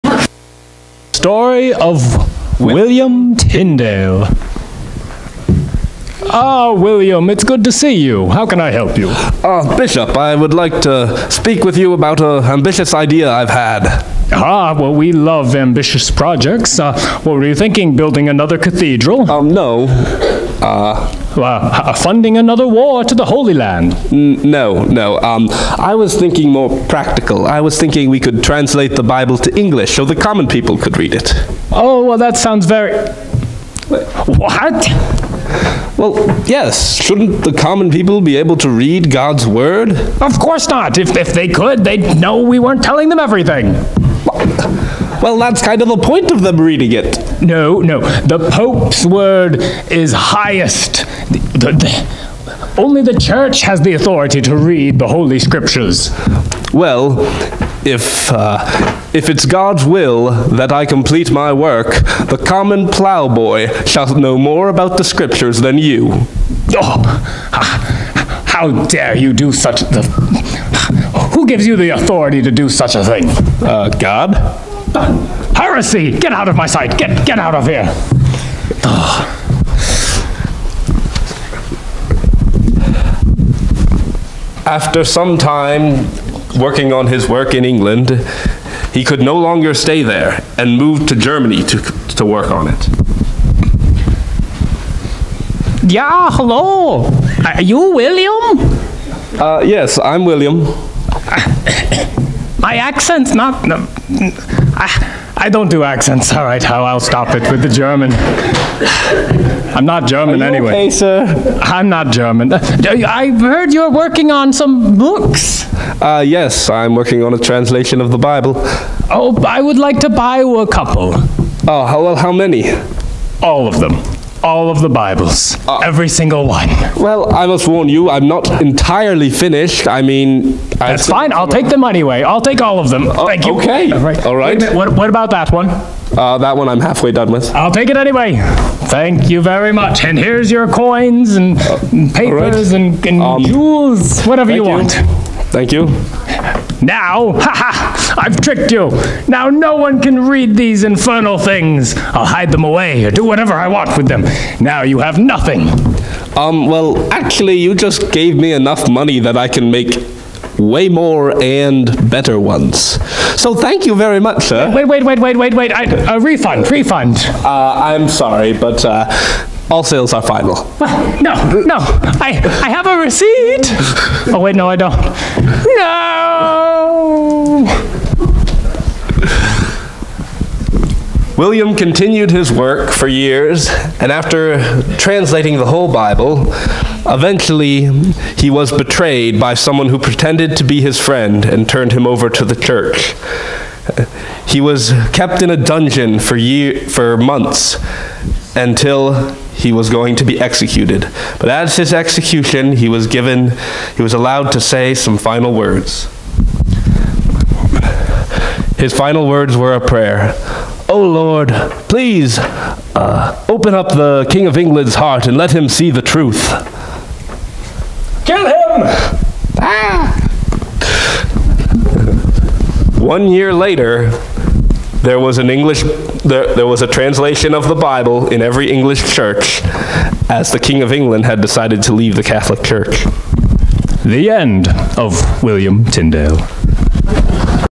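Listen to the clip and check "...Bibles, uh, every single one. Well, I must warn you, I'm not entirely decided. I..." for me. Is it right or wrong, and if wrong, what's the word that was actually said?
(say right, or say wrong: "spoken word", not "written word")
wrong: "finished", not "decided".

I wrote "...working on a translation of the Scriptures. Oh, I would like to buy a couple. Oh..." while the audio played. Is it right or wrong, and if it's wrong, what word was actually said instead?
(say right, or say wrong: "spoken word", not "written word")
wrong: "Bible", not "Scriptures".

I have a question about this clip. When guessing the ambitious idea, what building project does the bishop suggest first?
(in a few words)
Another cathedral.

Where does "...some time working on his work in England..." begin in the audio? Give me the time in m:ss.
1:25.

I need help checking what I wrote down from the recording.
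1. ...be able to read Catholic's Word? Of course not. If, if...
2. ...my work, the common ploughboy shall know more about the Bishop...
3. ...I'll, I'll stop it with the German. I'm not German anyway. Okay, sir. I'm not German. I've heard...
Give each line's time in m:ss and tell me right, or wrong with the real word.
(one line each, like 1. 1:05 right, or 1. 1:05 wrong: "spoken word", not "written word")
1. 0:38 wrong: "God", not "Catholic"
2. 1:01 wrong: "Scriptures", not "Bishop"
3. 1:46 right.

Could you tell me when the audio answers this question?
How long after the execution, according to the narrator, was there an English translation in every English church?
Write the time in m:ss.
3:42.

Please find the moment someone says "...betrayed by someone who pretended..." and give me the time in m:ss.
3:08.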